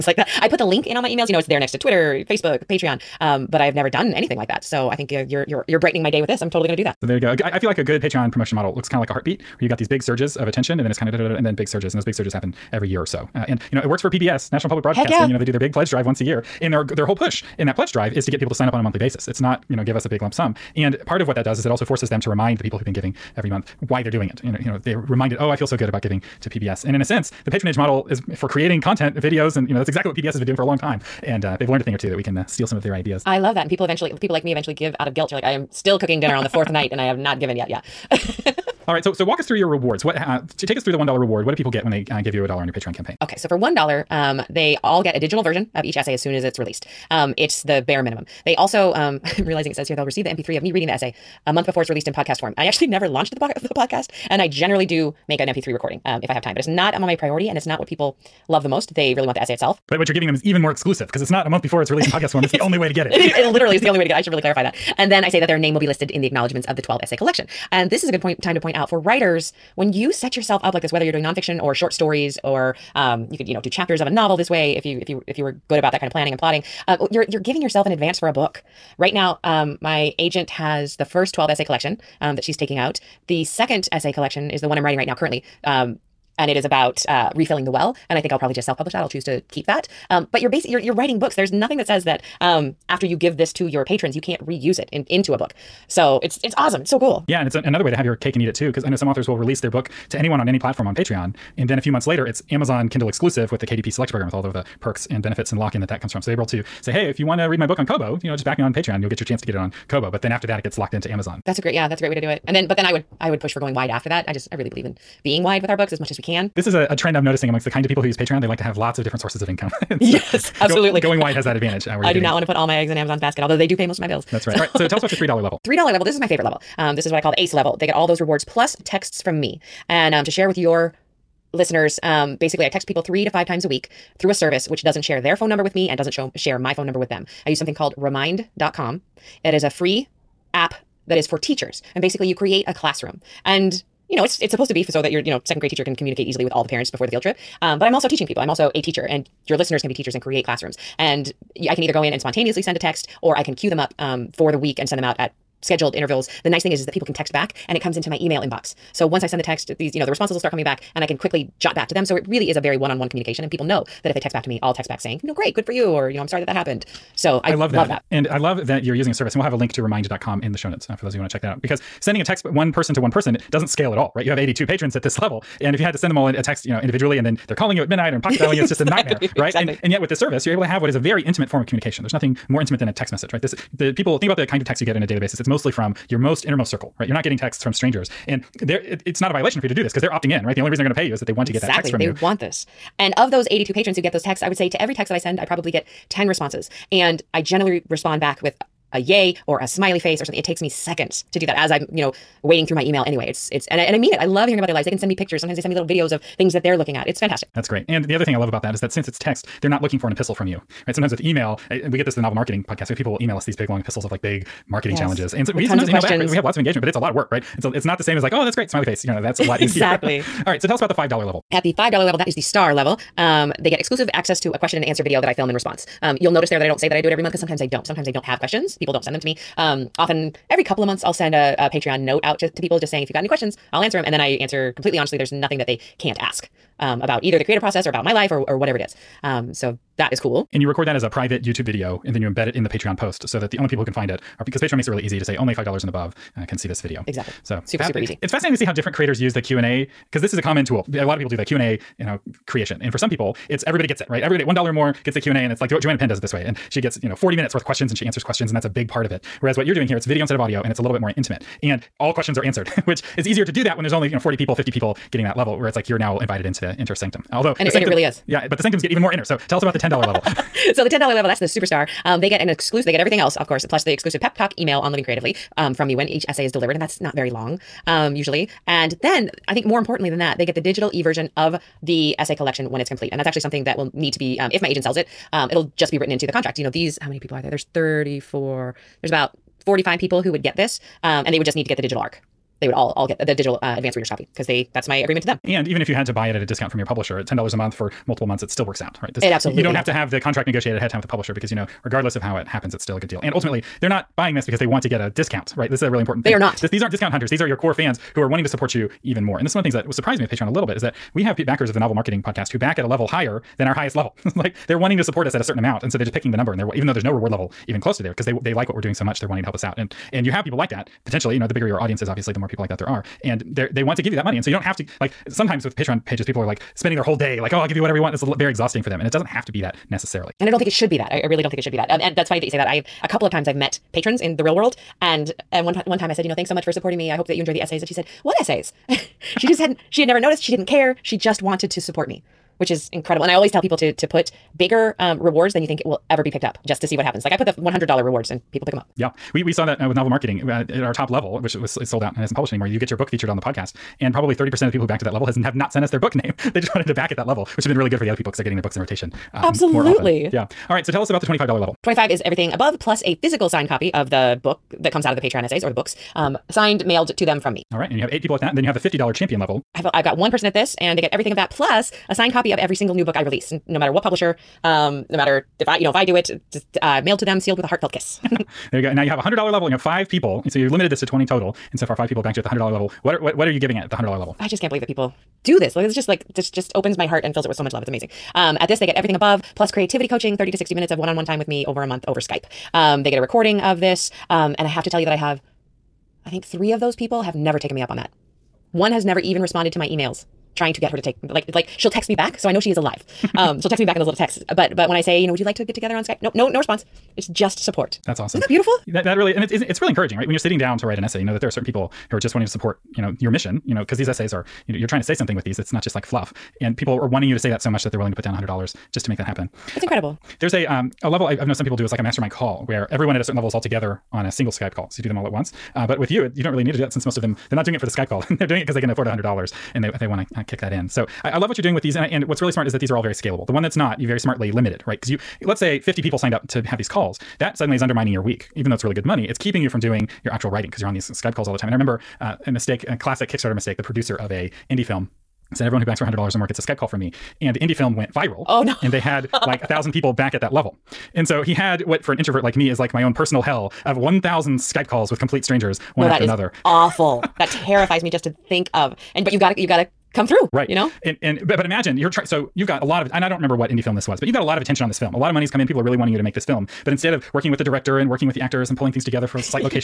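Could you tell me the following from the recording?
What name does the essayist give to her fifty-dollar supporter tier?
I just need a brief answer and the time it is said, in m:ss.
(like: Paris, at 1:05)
champion, at 6:09.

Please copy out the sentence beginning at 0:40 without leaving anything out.
What uh, to take us through the one dollar reward?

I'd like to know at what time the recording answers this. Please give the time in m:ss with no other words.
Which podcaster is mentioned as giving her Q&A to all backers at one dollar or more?
4:15.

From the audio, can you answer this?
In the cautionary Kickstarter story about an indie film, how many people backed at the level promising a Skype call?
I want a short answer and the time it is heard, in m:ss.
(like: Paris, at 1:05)
1,000, at 7:29.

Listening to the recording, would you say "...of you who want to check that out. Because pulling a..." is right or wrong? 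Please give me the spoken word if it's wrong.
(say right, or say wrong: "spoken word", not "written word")
wrong: "sending", not "pulling".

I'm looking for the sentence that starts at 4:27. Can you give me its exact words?
Although and it, sanctum, and it, really is.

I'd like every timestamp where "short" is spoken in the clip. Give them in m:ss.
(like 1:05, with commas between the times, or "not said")
1:11.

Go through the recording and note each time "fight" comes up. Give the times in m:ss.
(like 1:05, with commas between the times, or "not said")
not said.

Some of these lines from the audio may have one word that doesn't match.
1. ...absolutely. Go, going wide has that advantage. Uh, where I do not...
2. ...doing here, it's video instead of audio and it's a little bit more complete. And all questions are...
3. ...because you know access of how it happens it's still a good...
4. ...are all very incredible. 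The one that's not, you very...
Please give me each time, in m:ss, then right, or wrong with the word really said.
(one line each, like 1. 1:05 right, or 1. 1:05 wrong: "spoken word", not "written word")
1. 2:00 right
2. 4:19 wrong: "intimate", not "complete"
3. 5:01 wrong: "regardless", not "access"
4. 7:12 wrong: "scalable", not "incredible".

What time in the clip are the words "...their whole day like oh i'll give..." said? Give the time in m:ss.
5:26.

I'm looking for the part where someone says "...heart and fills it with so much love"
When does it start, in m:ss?
6:27.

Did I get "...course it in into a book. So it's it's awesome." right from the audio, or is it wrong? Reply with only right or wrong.
wrong.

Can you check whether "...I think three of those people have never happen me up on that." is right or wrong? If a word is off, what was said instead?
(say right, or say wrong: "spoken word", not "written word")
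wrong: "taken", not "happen".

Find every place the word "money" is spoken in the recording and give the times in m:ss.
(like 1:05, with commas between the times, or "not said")
5:24, 7:19, 7:45.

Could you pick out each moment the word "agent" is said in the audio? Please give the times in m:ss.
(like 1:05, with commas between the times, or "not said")
1:20, 4:44.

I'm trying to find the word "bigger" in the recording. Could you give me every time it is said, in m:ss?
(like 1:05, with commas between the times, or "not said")
5:21, 5:44.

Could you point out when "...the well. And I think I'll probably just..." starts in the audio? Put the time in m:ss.
1:27.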